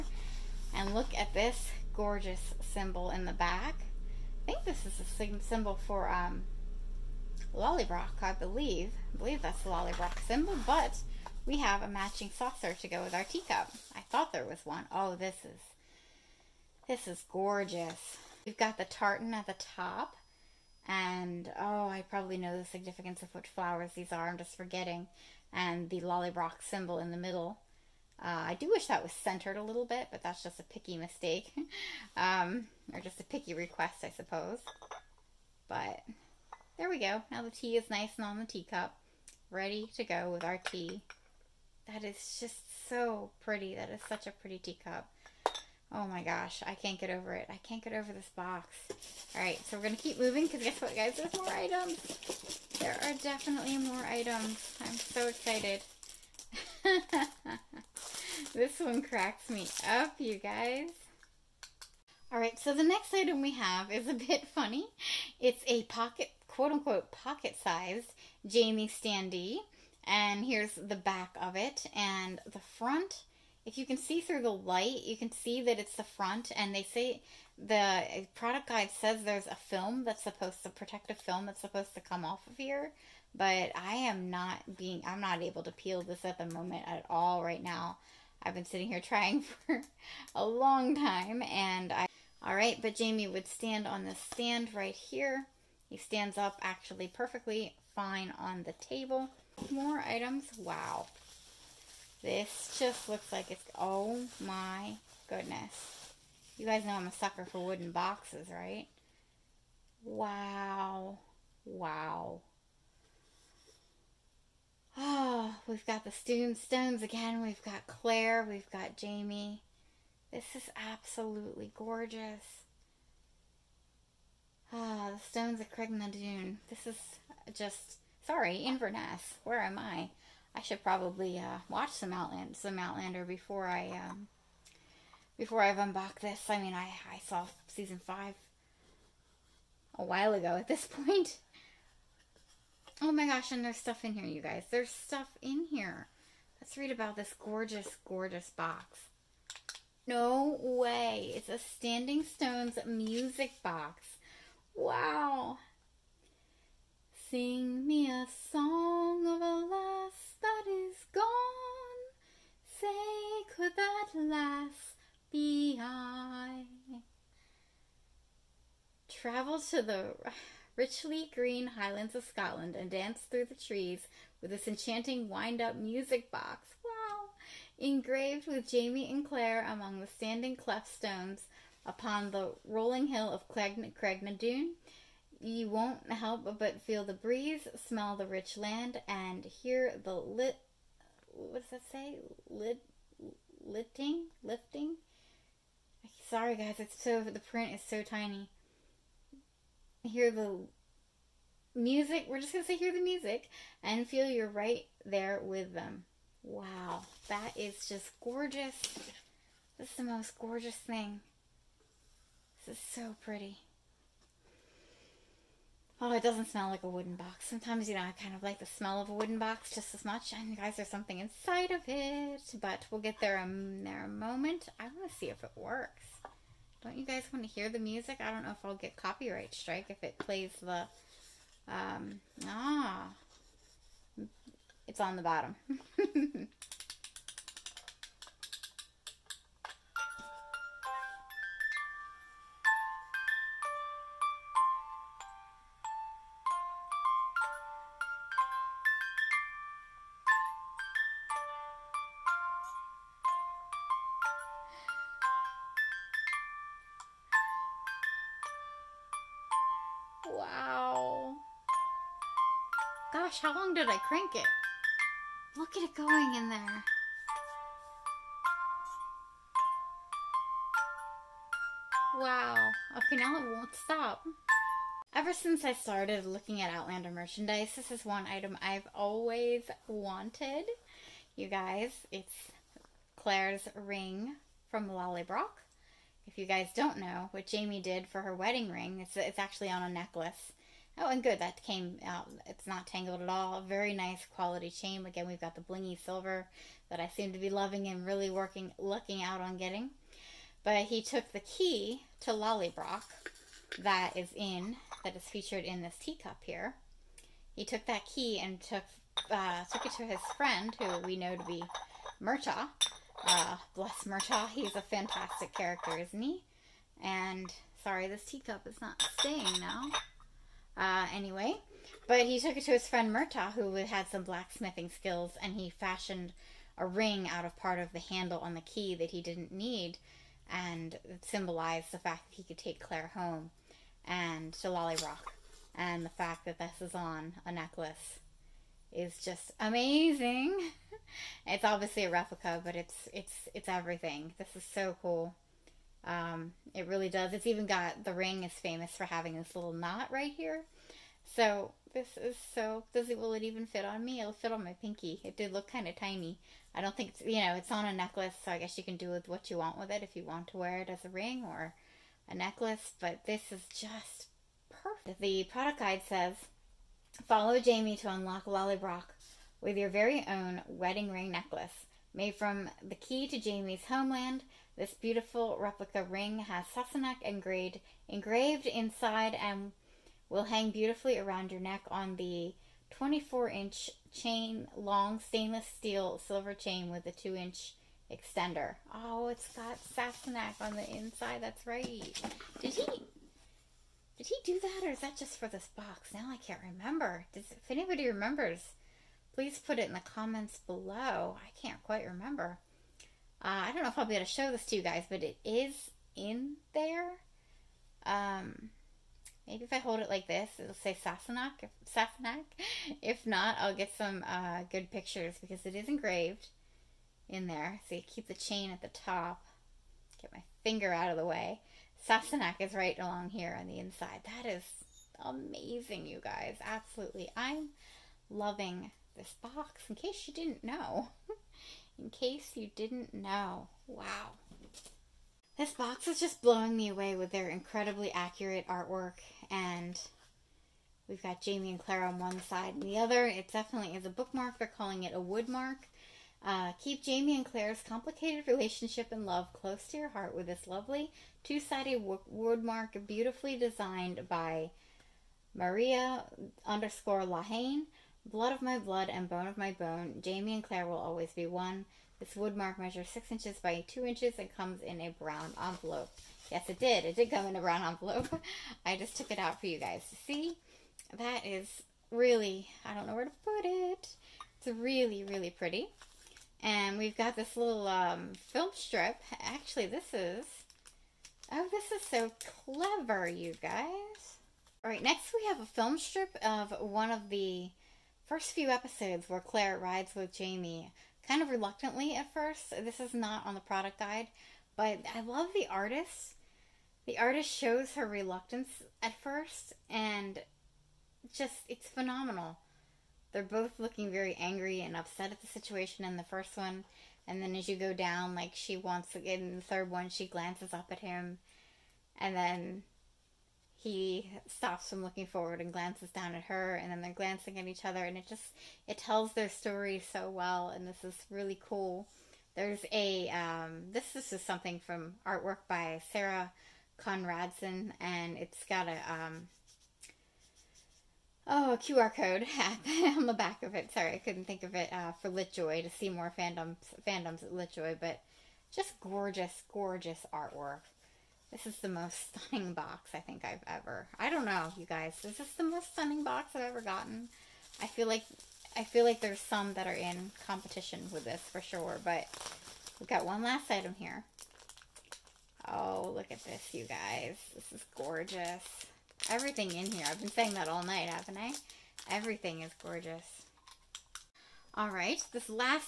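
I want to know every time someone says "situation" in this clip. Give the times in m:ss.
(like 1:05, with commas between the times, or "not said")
8:25.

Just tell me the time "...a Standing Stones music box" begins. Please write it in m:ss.
2:31.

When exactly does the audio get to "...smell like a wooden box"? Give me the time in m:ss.
3:36.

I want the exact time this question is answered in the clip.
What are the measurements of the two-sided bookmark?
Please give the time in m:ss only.
7:43.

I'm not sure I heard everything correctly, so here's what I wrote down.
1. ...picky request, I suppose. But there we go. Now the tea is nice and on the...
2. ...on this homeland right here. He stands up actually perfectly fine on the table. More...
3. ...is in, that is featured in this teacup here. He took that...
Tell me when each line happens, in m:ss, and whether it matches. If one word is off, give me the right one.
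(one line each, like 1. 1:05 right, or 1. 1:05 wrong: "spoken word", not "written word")
1. 0:33 right
2. 1:33 wrong: "stand", not "homeland"
3. 5:04 right.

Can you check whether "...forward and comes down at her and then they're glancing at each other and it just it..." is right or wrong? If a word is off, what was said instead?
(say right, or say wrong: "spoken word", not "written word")
wrong: "glances", not "comes".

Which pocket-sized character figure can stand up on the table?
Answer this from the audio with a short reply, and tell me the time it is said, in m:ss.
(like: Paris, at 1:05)
Jamie standee, at 1:08.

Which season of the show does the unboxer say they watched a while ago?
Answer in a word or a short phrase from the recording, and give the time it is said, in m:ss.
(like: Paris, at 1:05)
season 5, at 2:17.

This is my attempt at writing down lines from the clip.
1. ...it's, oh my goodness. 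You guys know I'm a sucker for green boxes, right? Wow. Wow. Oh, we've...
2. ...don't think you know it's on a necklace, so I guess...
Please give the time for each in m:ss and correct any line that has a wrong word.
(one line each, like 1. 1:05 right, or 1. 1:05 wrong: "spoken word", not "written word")
1. 1:43 wrong: "wooden", not "green"
2. 5:56 right.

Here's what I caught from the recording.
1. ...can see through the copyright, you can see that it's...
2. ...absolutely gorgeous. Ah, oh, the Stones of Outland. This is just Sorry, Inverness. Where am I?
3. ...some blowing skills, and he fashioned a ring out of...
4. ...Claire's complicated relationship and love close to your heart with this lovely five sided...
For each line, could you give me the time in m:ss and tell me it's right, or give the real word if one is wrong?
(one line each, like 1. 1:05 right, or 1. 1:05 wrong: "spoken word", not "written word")
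1. 1:13 wrong: "light", not "copyright"
2. 2:00 wrong: "Dune", not "Outland"
3. 5:24 wrong: "blacksmithing", not "blowing"
4. 7:27 wrong: "two", not "five".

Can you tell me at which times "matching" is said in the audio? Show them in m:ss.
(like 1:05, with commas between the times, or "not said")
0:11.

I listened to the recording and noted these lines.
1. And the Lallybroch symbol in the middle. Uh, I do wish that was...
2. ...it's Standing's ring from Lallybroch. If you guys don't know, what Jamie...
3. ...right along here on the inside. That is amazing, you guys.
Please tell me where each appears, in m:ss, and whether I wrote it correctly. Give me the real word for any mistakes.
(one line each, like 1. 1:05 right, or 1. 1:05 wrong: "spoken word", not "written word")
1. 0:25 right
2. 4:42 wrong: "Claire", not "Standing"
3. 7:02 right.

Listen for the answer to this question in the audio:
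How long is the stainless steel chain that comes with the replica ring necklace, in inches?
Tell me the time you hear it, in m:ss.
6:22.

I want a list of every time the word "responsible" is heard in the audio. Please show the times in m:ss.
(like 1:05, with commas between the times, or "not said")
not said.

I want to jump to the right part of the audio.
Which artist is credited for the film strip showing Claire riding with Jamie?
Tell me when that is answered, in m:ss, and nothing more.
8:46.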